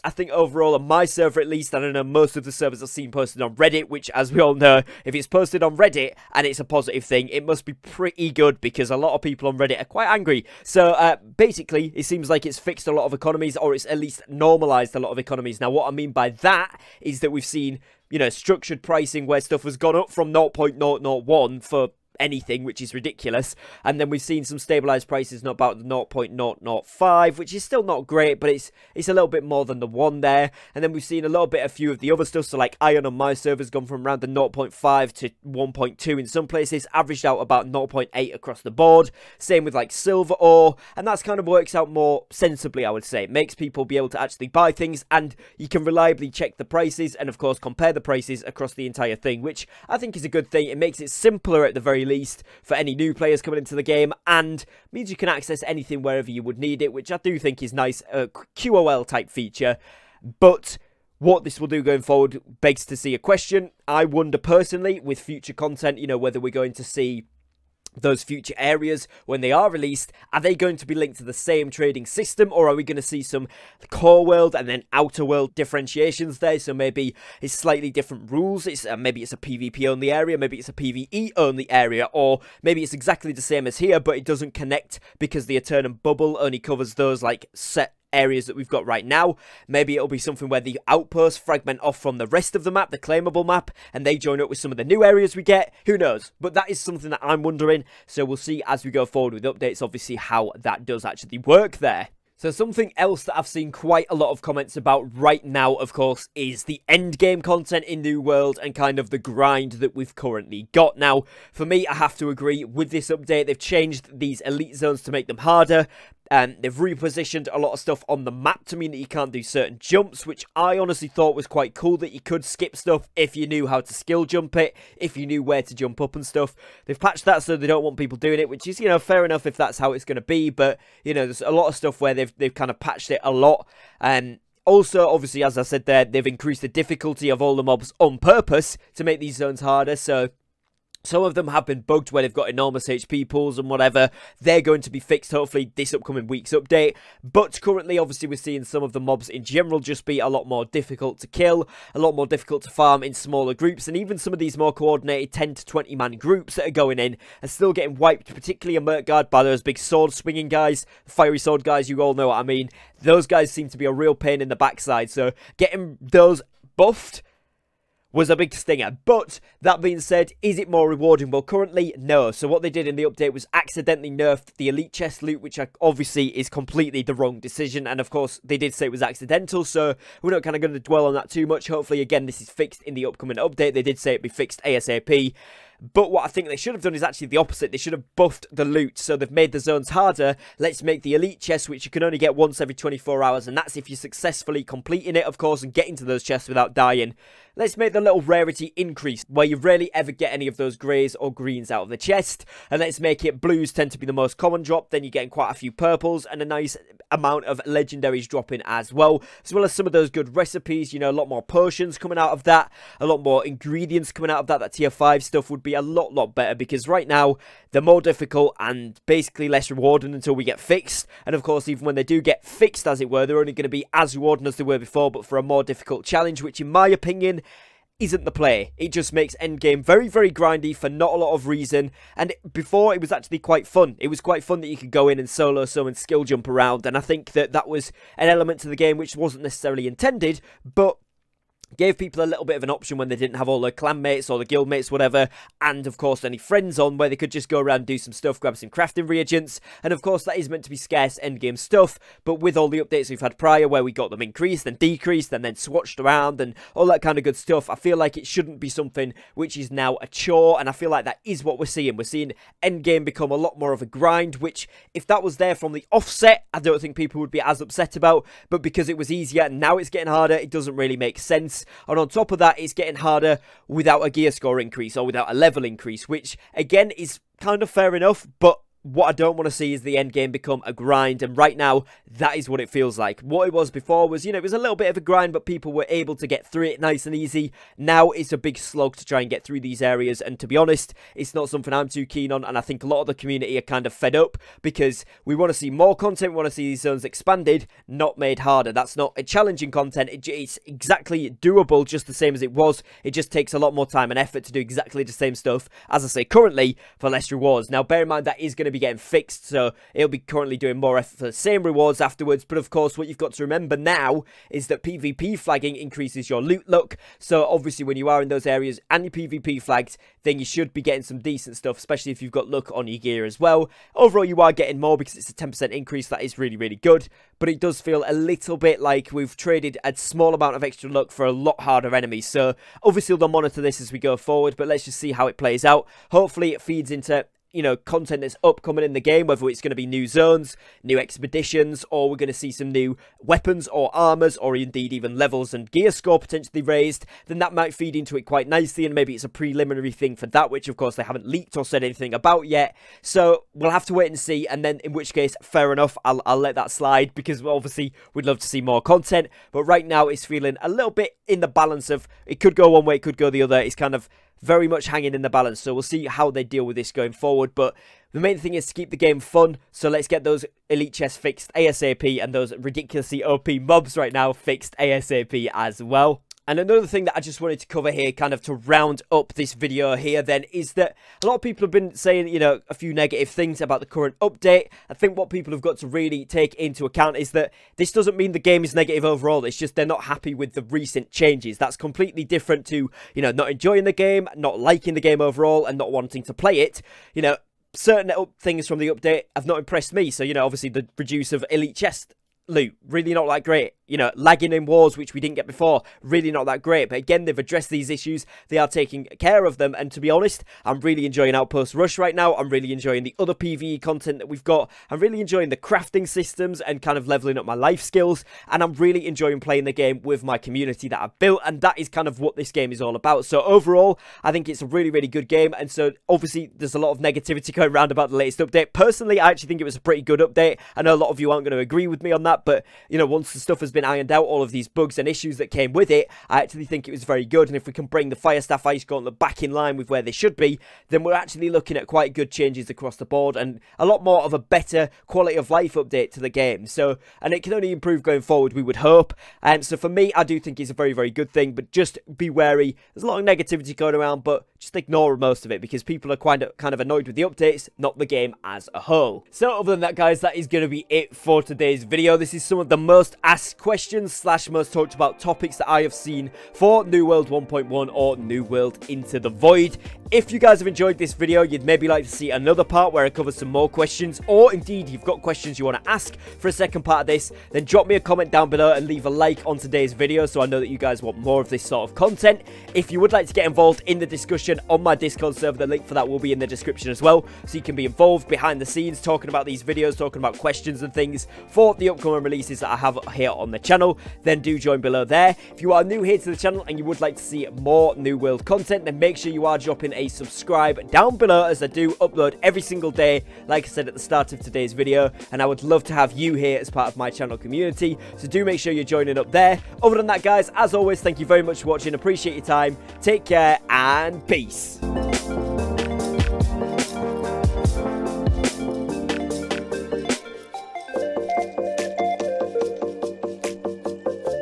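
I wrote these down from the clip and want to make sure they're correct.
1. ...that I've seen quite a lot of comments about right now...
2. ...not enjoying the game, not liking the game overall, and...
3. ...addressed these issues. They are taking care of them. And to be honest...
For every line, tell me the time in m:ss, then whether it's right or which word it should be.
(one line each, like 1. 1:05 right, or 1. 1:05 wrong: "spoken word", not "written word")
1. 1:43 right
2. 6:33 right
3. 6:47 right.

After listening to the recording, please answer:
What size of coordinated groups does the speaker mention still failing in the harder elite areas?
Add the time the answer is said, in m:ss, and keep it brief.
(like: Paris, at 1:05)
10 to 20 man, at 2:35.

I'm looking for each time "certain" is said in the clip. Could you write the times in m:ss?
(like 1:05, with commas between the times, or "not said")
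1:59, 6:37.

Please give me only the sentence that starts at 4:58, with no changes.
That's not a challenging content, it's exactly doable, just the same as it was.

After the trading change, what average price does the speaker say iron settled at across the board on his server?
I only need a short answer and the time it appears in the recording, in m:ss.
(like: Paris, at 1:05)
0.8, at 0:37.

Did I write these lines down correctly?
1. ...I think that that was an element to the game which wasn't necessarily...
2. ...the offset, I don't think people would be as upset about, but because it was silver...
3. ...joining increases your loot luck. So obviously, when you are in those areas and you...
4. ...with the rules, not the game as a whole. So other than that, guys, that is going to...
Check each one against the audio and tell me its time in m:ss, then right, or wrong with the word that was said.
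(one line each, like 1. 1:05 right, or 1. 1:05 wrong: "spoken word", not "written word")
1. 3:56 right
2. 4:25 wrong: "easier", not "silver"
3. 5:15 wrong: "flagging", not "joining"
4. 7:37 wrong: "updates", not "rules".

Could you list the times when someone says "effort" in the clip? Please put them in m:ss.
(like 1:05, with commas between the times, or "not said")
5:04, 5:10.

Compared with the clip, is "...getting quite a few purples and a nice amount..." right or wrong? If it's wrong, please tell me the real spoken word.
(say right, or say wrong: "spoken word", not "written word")
right.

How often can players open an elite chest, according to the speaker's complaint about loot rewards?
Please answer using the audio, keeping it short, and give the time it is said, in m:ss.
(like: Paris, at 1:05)
once every 24 hours, at 3:12.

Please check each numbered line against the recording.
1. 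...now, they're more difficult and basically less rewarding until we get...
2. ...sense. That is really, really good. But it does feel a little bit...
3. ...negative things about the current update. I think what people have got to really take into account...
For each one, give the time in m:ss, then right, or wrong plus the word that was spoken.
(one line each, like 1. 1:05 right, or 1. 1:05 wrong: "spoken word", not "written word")
1. 3:37 right
2. 5:25 wrong: "increase", not "sense"
3. 6:22 right.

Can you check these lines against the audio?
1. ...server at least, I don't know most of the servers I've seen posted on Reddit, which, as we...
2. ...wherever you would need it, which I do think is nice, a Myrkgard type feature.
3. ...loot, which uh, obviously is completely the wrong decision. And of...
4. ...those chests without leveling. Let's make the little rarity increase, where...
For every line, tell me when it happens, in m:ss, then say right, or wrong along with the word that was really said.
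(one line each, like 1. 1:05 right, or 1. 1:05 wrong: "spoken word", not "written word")
1. 0:01 right
2. 0:56 wrong: "QOL", not "Myrkgard"
3. 2:55 right
4. 3:16 wrong: "dying", not "leveling".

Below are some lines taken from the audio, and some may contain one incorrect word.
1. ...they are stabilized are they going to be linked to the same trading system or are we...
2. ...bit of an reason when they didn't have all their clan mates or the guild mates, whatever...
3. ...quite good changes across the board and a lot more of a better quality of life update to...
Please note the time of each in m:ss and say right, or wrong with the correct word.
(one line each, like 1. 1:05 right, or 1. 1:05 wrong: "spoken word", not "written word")
1. 1:09 wrong: "released", not "stabilized"
2. 4:02 wrong: "option", not "reason"
3. 7:21 right.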